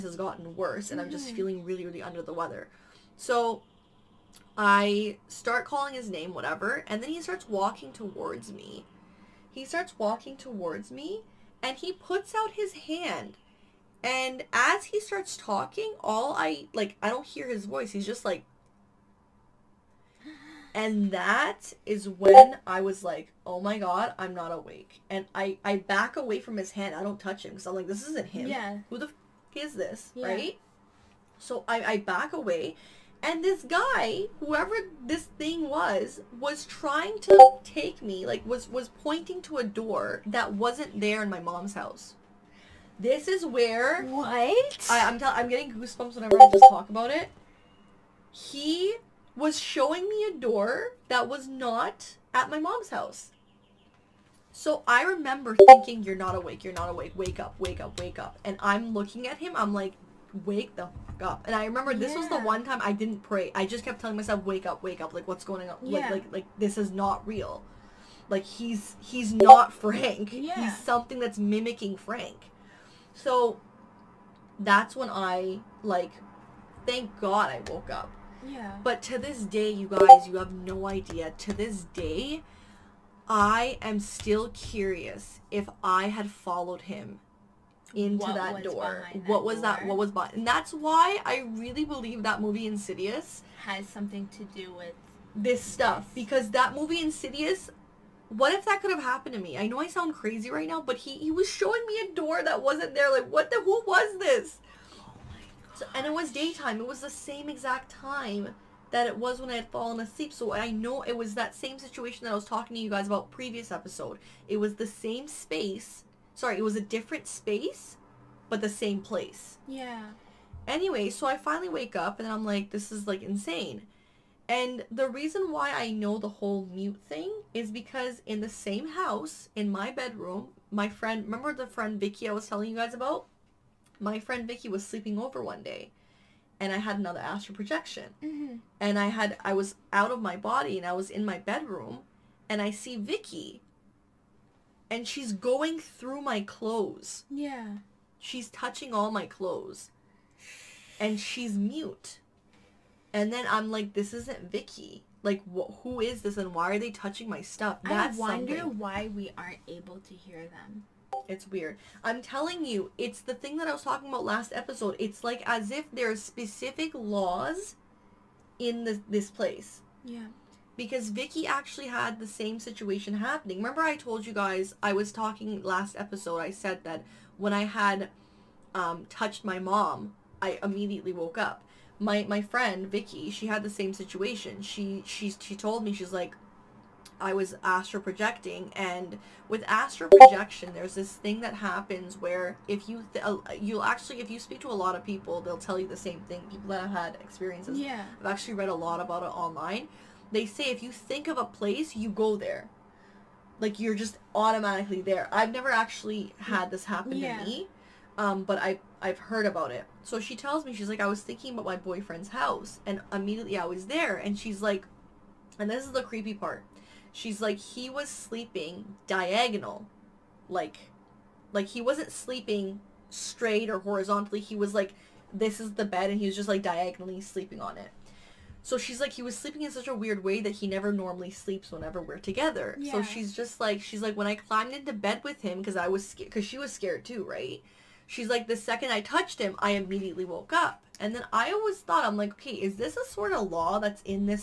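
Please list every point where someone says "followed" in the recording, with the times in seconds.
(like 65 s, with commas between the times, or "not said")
86 s.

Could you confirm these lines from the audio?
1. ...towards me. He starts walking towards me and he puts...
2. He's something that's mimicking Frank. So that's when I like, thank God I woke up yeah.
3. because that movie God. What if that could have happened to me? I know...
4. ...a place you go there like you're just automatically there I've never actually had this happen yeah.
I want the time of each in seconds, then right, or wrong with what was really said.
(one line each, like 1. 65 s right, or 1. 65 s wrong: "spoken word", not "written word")
1. 7 s right
2. 70 s right
3. 96 s wrong: "Insidious", not "God"
4. 201 s right.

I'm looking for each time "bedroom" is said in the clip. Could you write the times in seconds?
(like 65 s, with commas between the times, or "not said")
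129 s, 141 s.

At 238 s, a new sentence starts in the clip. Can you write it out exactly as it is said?
She's like, the second I touched him, I immediately woke up.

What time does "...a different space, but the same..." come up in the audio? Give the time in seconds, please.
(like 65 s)
116 s.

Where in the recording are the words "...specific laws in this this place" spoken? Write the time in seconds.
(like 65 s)
166 s.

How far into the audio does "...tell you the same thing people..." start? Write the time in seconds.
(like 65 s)
195 s.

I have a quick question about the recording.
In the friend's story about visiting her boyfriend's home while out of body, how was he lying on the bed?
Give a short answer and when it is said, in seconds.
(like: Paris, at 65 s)
Diagonally, at 219 s.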